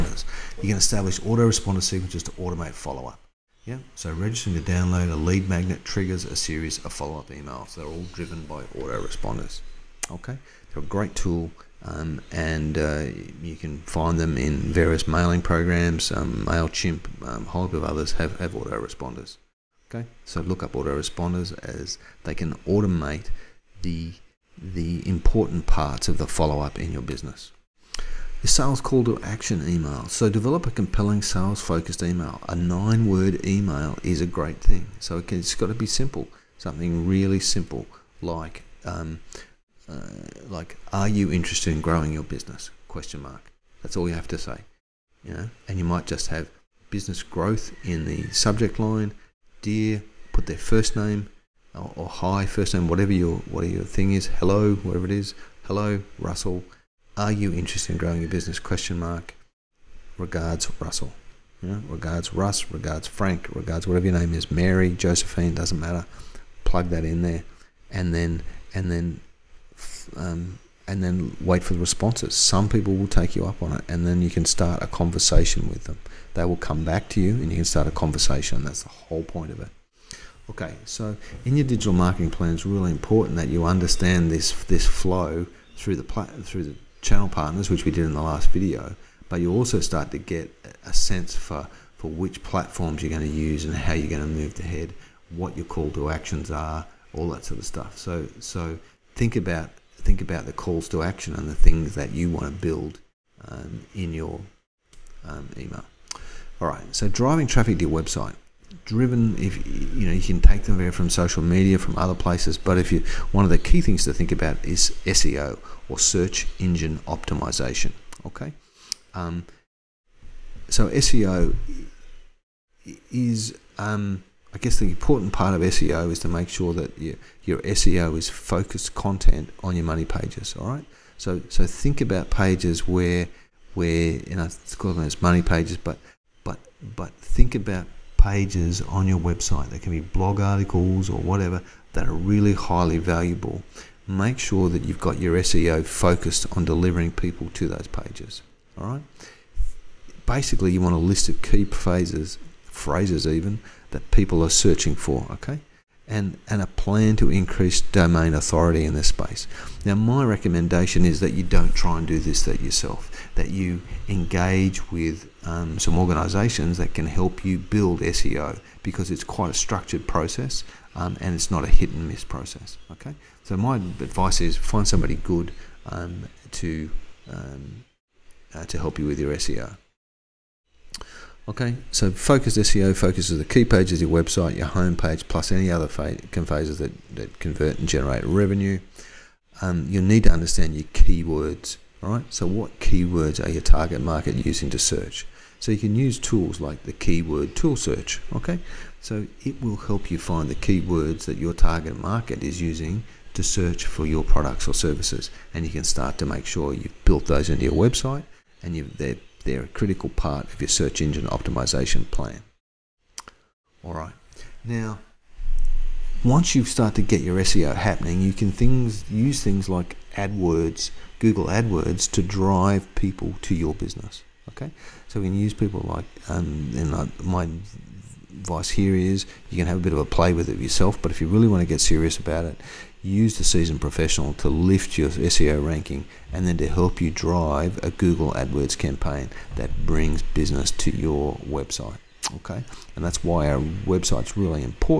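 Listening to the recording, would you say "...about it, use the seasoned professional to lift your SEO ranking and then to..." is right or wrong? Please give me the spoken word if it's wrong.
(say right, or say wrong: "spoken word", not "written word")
right.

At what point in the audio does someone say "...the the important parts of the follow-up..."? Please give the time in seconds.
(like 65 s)
23 s.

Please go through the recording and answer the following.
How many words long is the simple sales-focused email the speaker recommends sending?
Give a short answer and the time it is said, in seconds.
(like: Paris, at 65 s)
9, at 32 s.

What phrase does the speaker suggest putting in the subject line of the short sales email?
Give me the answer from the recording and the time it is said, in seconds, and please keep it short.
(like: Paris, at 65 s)
business growth, at 46 s.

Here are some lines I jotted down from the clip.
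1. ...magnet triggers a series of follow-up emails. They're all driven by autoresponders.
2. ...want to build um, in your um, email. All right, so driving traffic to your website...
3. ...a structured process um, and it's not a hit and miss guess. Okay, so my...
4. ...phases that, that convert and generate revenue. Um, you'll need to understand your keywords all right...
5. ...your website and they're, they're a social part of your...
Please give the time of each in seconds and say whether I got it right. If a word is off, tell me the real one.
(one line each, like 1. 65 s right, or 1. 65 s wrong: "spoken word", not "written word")
1. 5 s right
2. 102 s right
3. 169 s wrong: "process", not "guess"
4. 185 s right
5. 207 s wrong: "critical", not "social".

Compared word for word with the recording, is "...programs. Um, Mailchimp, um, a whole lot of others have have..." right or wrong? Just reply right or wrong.
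right.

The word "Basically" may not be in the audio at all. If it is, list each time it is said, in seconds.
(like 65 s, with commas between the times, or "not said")
150 s.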